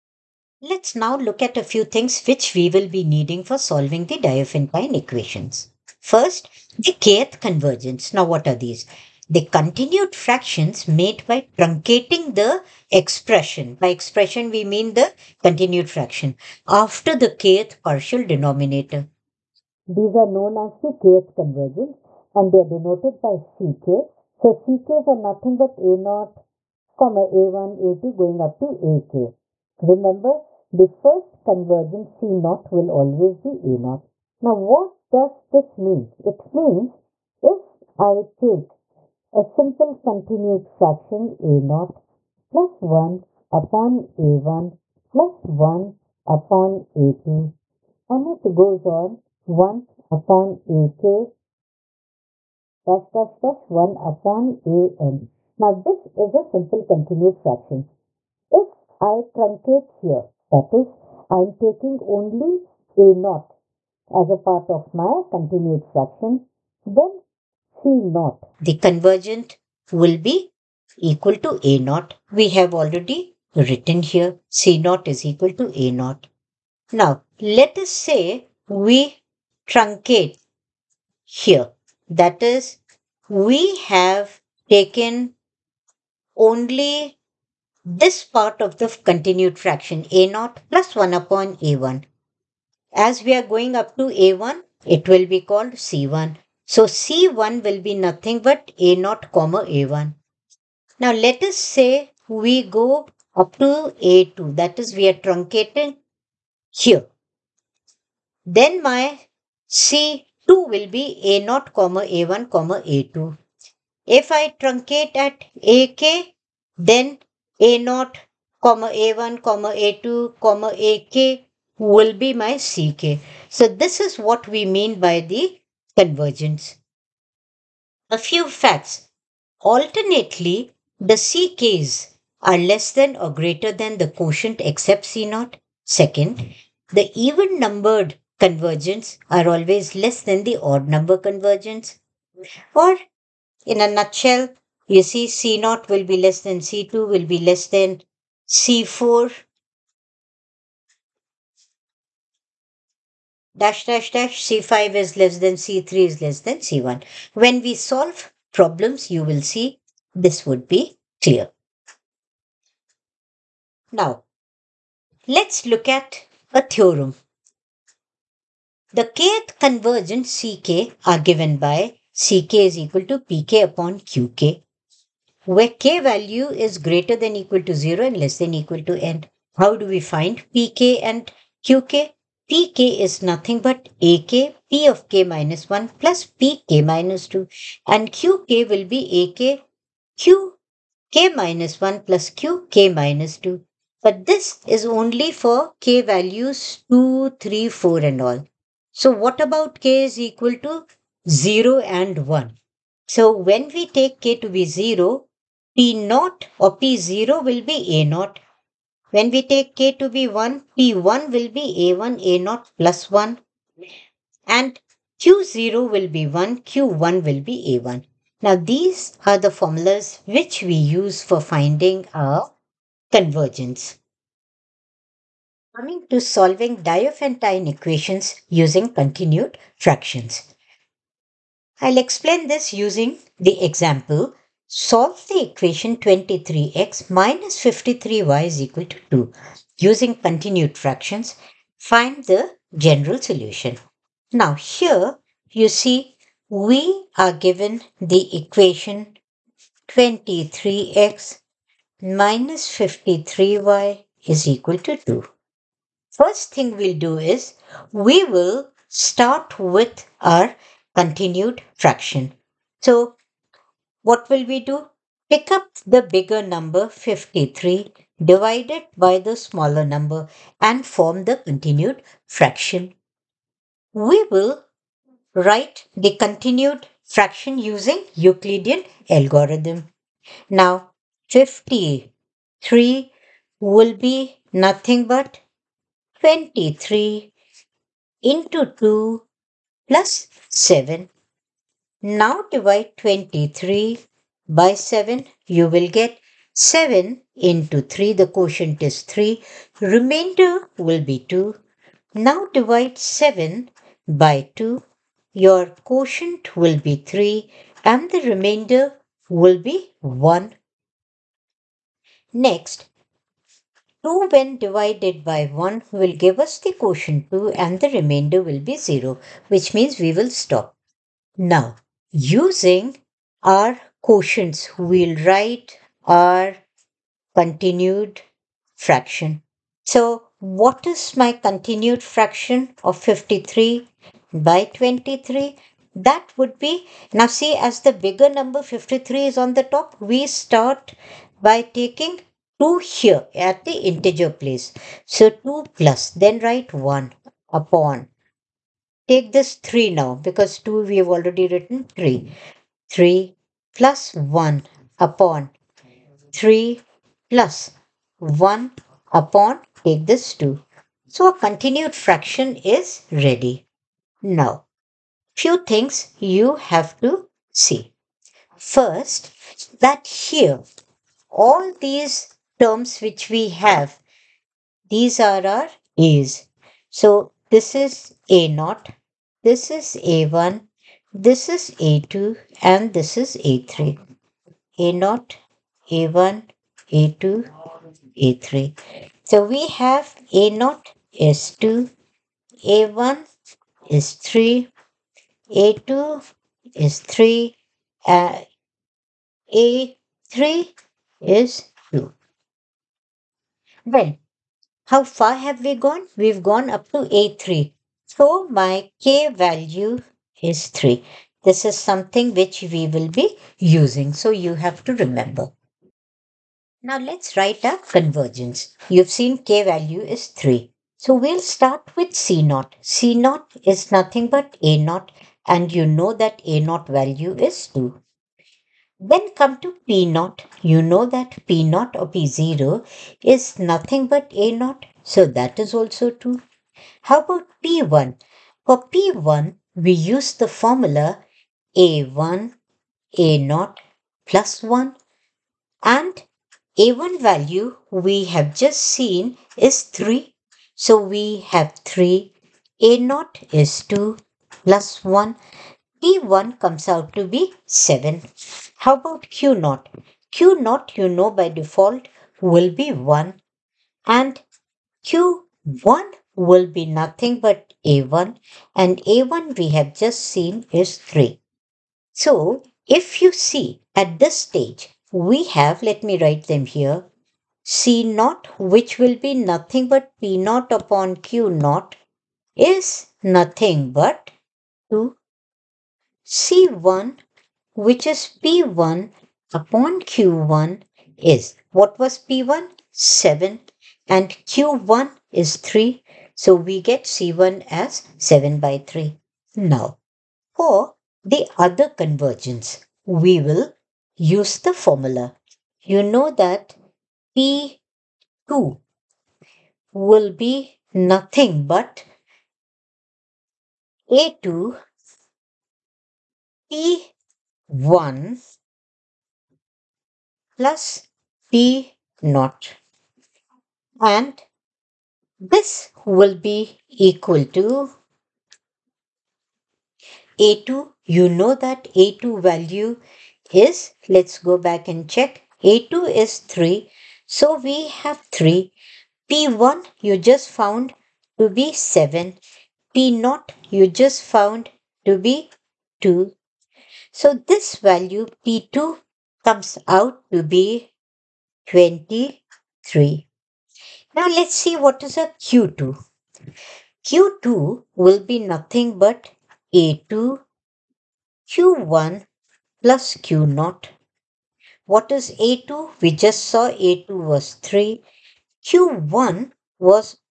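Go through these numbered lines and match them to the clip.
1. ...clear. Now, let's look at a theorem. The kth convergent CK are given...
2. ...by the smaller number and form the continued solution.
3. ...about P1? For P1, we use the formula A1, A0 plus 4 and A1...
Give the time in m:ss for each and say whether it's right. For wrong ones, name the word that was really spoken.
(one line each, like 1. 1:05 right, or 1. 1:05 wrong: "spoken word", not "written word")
1. 2:41 right
2. 4:28 wrong: "fraction", not "solution"
3. 7:17 wrong: "1", not "4".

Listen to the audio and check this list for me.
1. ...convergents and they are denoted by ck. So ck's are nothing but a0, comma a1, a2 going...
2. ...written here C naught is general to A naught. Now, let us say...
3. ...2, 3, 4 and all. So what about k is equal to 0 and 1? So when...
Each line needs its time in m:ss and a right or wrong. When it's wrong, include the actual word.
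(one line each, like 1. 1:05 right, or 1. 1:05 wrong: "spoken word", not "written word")
1. 0:21 right
2. 1:13 wrong: "equal", not "general"
3. 3:16 right.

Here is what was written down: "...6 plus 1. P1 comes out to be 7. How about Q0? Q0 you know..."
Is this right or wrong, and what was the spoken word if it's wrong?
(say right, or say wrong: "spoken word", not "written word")
wrong: "2", not "6".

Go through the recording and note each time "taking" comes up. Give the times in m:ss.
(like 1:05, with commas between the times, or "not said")
1:01, 5:41.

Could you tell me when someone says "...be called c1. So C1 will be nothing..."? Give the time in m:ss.
1:35.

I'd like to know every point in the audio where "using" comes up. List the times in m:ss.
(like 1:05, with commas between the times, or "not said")
3:48, 3:52, 3:59, 4:37, 5:22, 6:53.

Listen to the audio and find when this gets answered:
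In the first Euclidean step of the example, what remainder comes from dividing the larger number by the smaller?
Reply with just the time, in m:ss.
4:46.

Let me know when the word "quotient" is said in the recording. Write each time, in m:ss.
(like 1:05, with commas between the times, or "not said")
2:14, 4:58, 5:05, 5:16, 5:24.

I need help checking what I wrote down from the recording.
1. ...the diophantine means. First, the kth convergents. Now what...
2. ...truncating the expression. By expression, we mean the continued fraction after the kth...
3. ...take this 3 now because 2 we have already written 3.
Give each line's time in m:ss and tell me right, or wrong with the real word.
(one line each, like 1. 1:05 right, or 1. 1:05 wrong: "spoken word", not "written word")
1. 0:04 wrong: "equations", not "means"
2. 0:11 right
3. 5:49 right.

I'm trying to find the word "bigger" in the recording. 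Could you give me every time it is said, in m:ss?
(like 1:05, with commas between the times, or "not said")
4:26, 5:37.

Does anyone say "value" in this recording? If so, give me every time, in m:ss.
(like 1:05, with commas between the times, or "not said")
2:56, 3:16, 6:49, 6:59, 7:06, 7:27, 8:52, 9:07.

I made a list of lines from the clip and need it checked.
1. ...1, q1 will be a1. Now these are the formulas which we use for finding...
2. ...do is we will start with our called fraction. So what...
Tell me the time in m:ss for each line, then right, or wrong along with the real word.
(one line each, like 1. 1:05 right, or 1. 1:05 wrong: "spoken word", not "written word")
1. 3:36 right
2. 4:16 wrong: "continued", not "called".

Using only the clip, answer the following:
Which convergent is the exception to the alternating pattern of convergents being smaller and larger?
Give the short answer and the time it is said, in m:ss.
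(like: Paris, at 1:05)
C0, at 2:14.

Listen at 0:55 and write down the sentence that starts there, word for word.
Now this is a simple continued fraction.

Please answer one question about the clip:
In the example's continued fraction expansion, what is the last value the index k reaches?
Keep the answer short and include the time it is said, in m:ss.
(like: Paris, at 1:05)
3, at 6:48.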